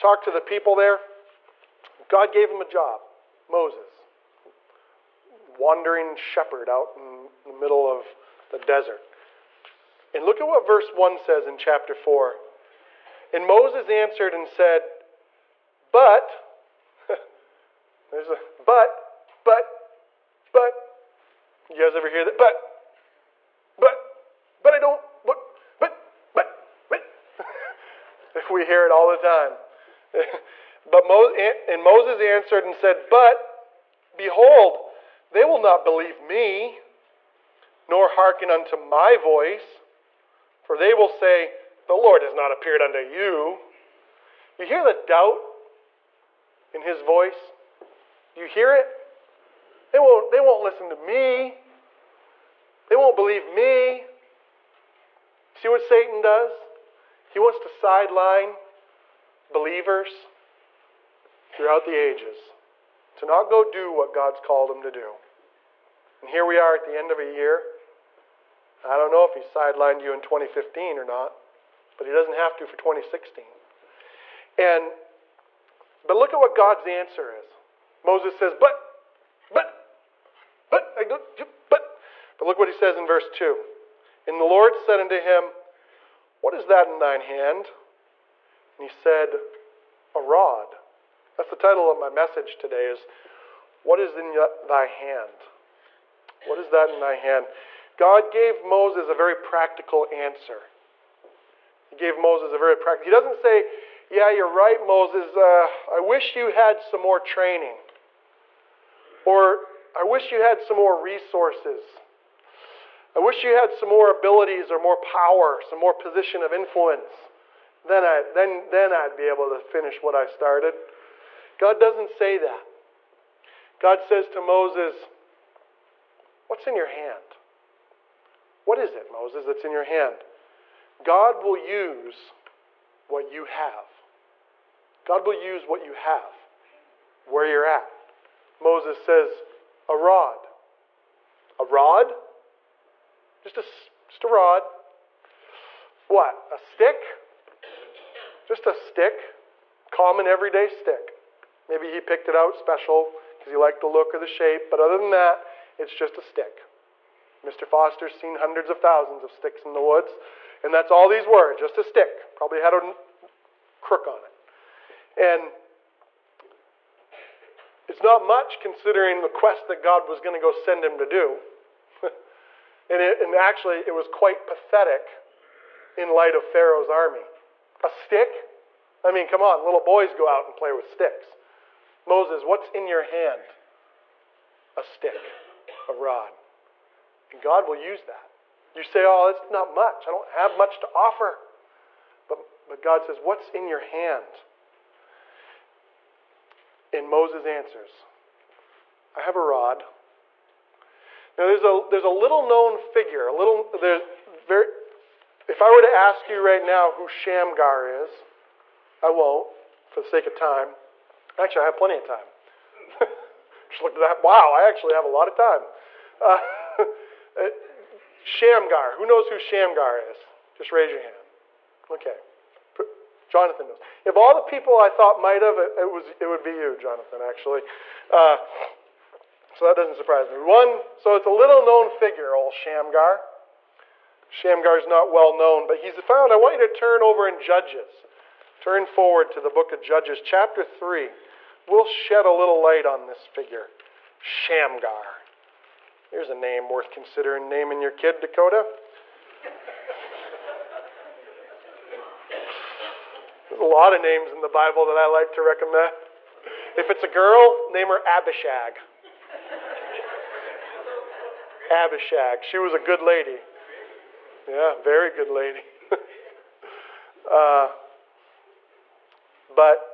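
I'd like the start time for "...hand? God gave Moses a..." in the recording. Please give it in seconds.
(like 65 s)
97 s.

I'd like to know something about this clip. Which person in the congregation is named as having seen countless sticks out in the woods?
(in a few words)
Mr. Foster.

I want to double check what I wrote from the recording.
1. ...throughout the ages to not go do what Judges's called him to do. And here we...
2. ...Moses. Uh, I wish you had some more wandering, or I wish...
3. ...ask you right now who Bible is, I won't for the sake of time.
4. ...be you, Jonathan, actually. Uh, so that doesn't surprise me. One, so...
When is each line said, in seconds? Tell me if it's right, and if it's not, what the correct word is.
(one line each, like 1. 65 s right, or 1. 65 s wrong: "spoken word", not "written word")
1. 61 s wrong: "God", not "Judges"
2. 104 s wrong: "training", not "wandering"
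3. 205 s wrong: "Shamgar", not "Bible"
4. 226 s right.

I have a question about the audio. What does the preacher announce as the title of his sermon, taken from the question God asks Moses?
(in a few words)
What is in thy hand?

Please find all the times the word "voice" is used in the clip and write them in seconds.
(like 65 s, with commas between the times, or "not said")
39 s, 47 s.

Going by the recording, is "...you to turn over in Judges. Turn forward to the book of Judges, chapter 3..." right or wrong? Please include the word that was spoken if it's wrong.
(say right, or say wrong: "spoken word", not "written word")
right.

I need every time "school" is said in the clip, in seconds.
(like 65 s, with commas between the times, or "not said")
not said.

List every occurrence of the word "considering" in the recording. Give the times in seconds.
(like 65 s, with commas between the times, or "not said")
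168 s, 246 s.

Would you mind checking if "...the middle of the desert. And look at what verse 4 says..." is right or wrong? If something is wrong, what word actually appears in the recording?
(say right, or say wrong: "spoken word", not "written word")
wrong: "1", not "4".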